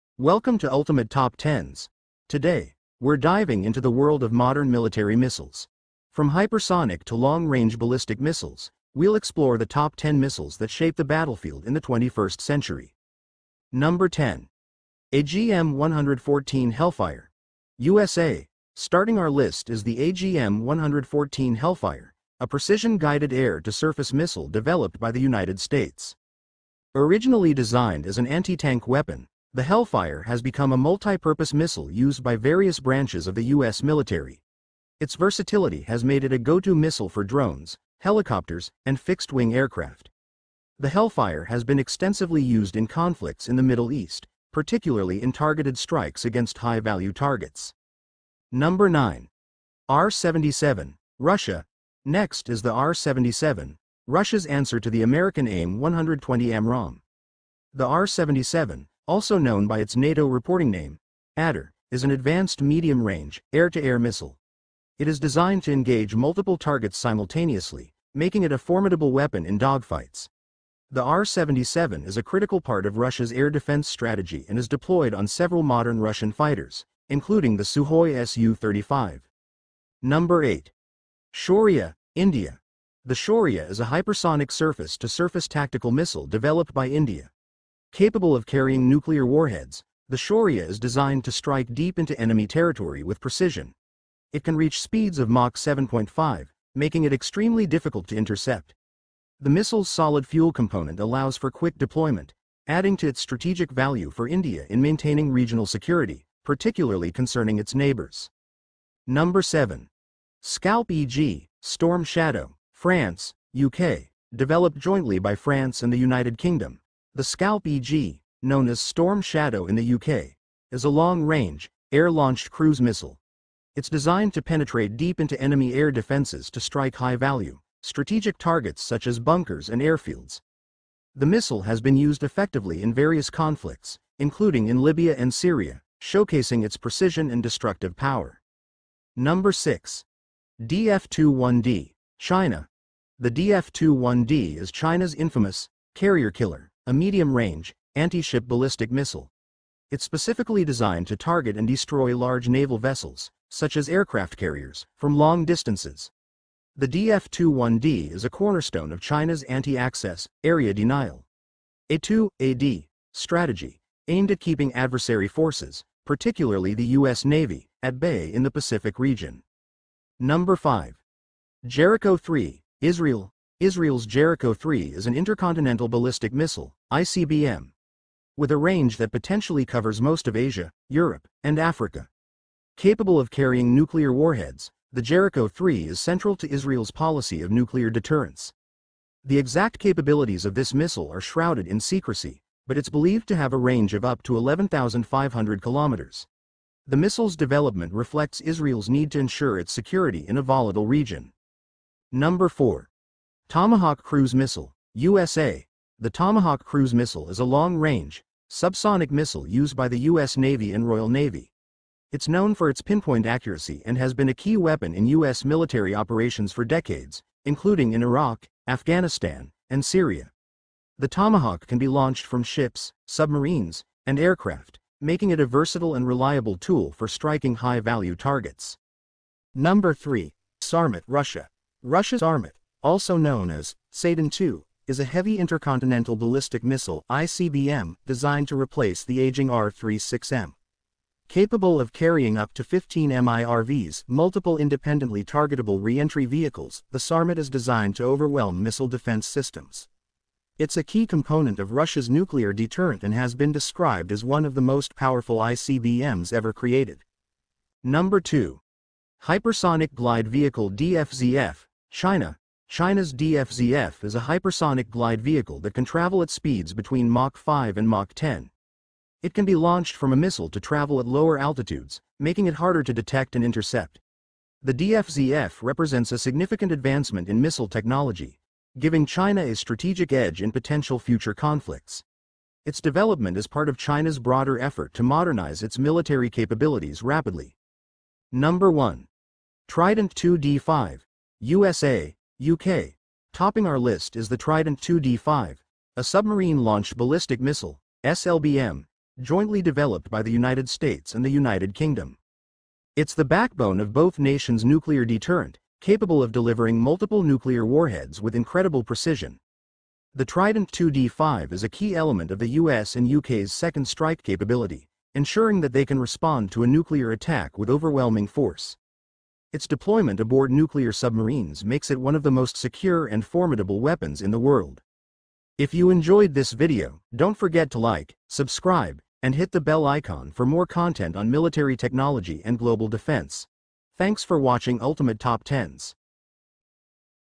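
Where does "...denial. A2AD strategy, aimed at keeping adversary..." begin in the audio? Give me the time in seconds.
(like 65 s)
160 s.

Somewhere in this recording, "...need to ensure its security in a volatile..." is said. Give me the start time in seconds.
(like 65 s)
198 s.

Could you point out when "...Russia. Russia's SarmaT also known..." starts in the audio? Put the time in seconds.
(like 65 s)
231 s.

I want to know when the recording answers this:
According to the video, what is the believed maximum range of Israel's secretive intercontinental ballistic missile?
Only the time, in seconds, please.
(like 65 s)
194 s.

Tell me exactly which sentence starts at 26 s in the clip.
Originally designed as an anti-tank weapon, the Hellfire has become a multi-purpose missile used by various branches of the U.S.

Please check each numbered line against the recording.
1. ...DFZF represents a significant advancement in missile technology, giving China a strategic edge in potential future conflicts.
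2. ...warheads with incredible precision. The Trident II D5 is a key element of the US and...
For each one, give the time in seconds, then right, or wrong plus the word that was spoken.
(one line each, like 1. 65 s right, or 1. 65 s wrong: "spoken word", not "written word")
1. 274 s right
2. 307 s right.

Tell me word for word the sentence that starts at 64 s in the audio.
It is designed to engage multiple targets simultaneously, making it a formidable weapon in dogfights.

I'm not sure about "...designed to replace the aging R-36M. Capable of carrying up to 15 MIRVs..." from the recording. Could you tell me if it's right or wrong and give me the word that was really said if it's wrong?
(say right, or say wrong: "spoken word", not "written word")
right.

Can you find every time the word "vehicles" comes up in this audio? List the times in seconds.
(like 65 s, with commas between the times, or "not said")
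246 s, 260 s, 265 s.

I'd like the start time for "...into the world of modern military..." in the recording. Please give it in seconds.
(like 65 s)
3 s.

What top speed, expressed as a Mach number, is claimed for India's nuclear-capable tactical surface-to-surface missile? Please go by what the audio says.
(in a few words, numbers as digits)
Mach 7.5.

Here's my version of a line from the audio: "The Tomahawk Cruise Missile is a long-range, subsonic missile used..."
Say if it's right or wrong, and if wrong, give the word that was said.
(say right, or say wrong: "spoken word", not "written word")
right.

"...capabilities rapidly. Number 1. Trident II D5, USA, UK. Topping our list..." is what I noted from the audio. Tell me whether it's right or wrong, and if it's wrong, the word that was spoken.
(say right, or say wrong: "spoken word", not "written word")
right.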